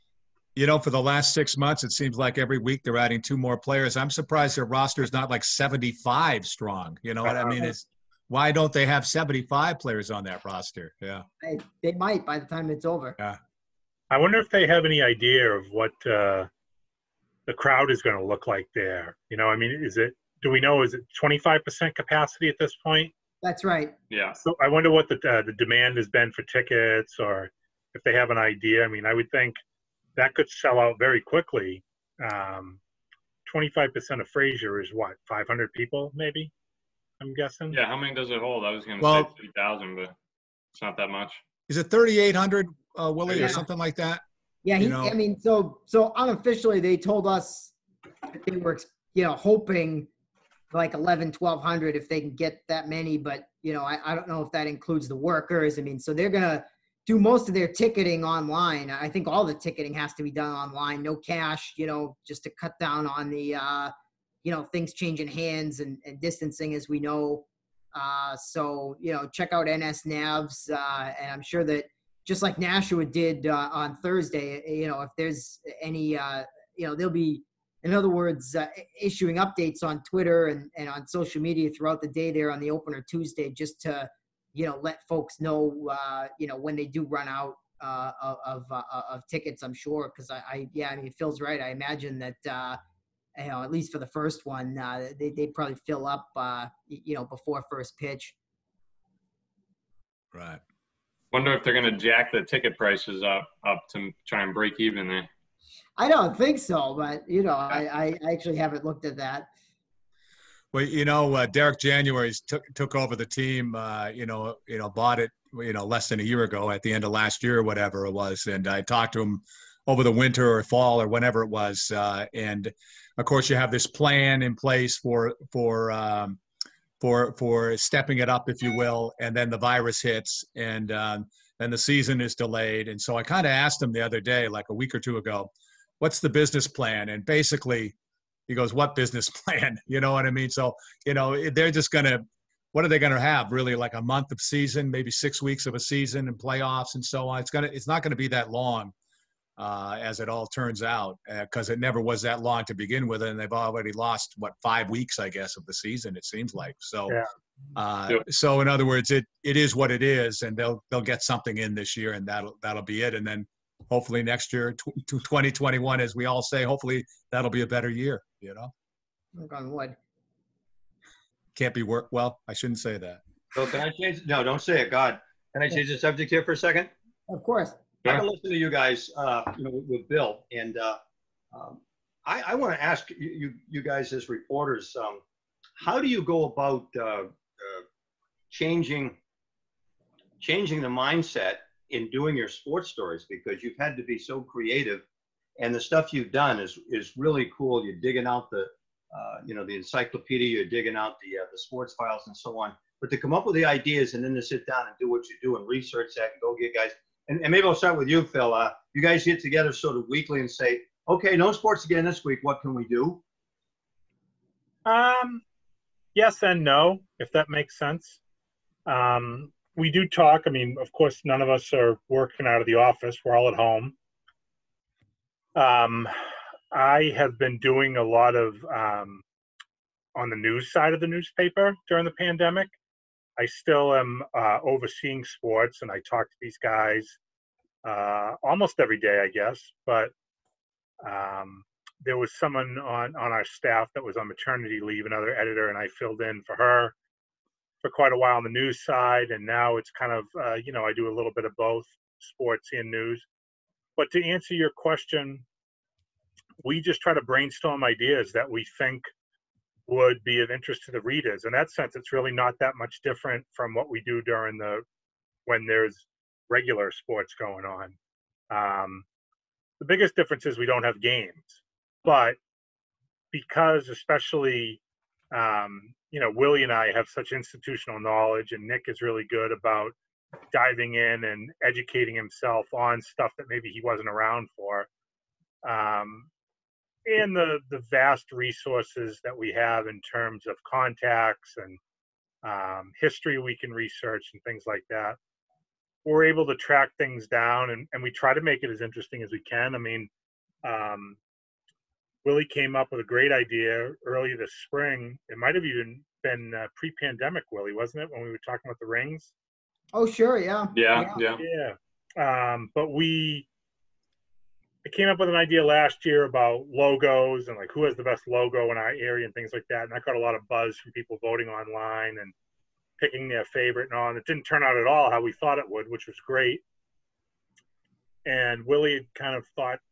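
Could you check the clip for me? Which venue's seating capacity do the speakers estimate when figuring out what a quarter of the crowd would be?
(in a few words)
Fraser.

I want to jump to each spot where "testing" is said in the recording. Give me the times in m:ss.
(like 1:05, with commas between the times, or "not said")
not said.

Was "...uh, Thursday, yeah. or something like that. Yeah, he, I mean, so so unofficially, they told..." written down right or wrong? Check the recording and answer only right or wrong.
wrong.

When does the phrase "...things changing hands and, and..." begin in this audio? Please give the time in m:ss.
1:04.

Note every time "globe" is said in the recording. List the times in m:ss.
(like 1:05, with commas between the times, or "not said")
not said.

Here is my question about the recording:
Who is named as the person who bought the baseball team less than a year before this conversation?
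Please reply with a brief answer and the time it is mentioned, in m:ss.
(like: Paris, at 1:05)
Derek January, at 1:51.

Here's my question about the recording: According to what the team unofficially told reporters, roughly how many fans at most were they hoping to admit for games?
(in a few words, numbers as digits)
1200.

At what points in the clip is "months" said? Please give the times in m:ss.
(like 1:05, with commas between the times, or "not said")
0:01, 2:24.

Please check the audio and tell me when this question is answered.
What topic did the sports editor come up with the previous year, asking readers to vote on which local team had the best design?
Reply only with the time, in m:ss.
5:16.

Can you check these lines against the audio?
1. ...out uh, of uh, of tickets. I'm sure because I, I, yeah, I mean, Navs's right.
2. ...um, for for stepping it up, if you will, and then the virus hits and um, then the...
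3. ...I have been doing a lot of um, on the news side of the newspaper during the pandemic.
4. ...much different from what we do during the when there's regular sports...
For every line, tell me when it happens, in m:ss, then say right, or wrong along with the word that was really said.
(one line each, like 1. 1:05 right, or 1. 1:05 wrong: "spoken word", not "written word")
1. 1:27 wrong: "Phil", not "Navs"
2. 2:05 right
3. 3:46 right
4. 4:22 right.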